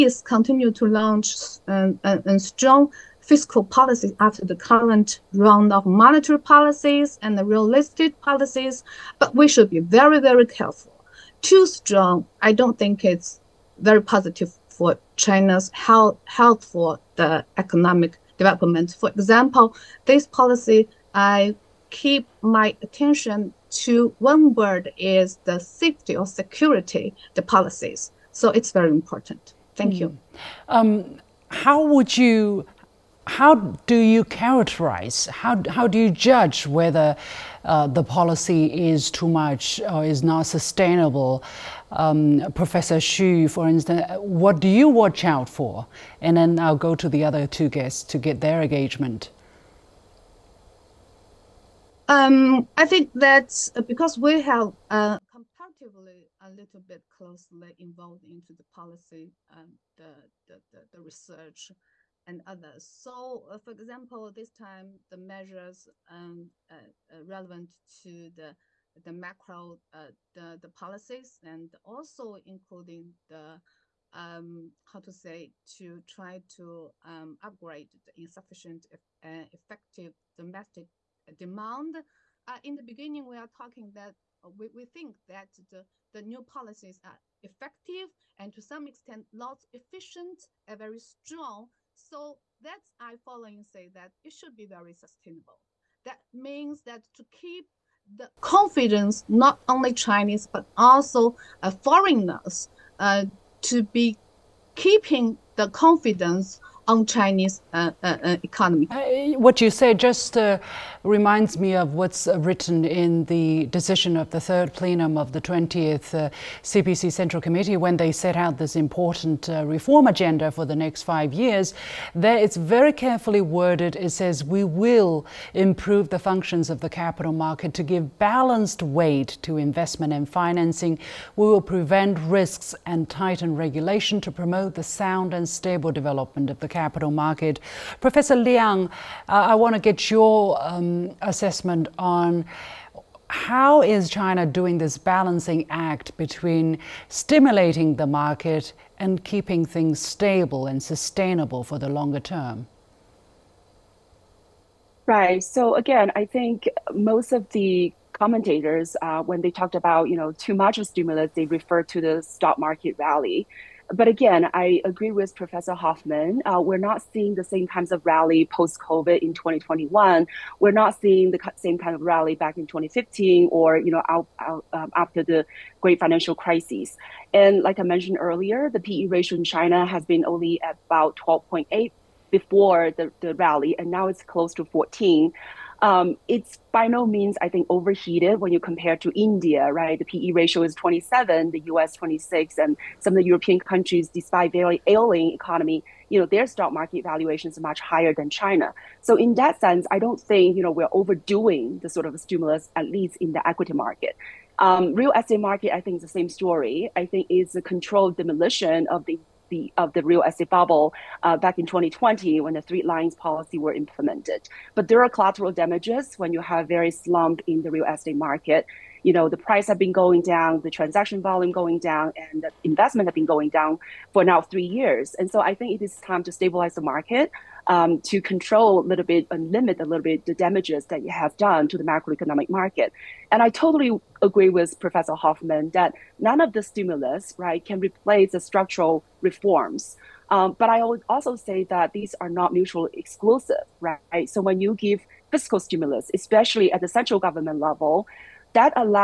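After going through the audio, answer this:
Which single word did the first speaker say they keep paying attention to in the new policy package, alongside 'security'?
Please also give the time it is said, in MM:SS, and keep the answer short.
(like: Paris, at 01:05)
Safety, at 00:25.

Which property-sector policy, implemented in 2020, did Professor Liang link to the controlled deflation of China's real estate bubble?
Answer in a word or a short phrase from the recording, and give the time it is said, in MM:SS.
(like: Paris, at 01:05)
Three lines policy, at 03:32.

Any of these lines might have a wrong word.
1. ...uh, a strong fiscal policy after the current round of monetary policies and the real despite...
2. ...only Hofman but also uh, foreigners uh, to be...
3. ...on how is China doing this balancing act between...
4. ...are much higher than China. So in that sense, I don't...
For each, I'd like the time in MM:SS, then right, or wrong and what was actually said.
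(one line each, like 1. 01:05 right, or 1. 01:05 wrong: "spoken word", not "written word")
1. 00:02 wrong: "estate", not "despite"
2. 01:39 wrong: "Chinese", not "Hofman"
3. 02:22 right
4. 03:17 right.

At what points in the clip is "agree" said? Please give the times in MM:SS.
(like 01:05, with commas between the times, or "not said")
02:44, 03:54.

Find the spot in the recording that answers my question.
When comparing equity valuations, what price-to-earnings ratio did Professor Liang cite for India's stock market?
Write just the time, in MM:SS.
03:10.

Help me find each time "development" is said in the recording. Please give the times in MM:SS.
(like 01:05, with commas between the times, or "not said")
00:18, 02:15.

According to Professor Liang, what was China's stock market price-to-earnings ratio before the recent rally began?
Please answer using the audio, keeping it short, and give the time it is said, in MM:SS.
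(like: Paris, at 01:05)
12.8, at 03:01.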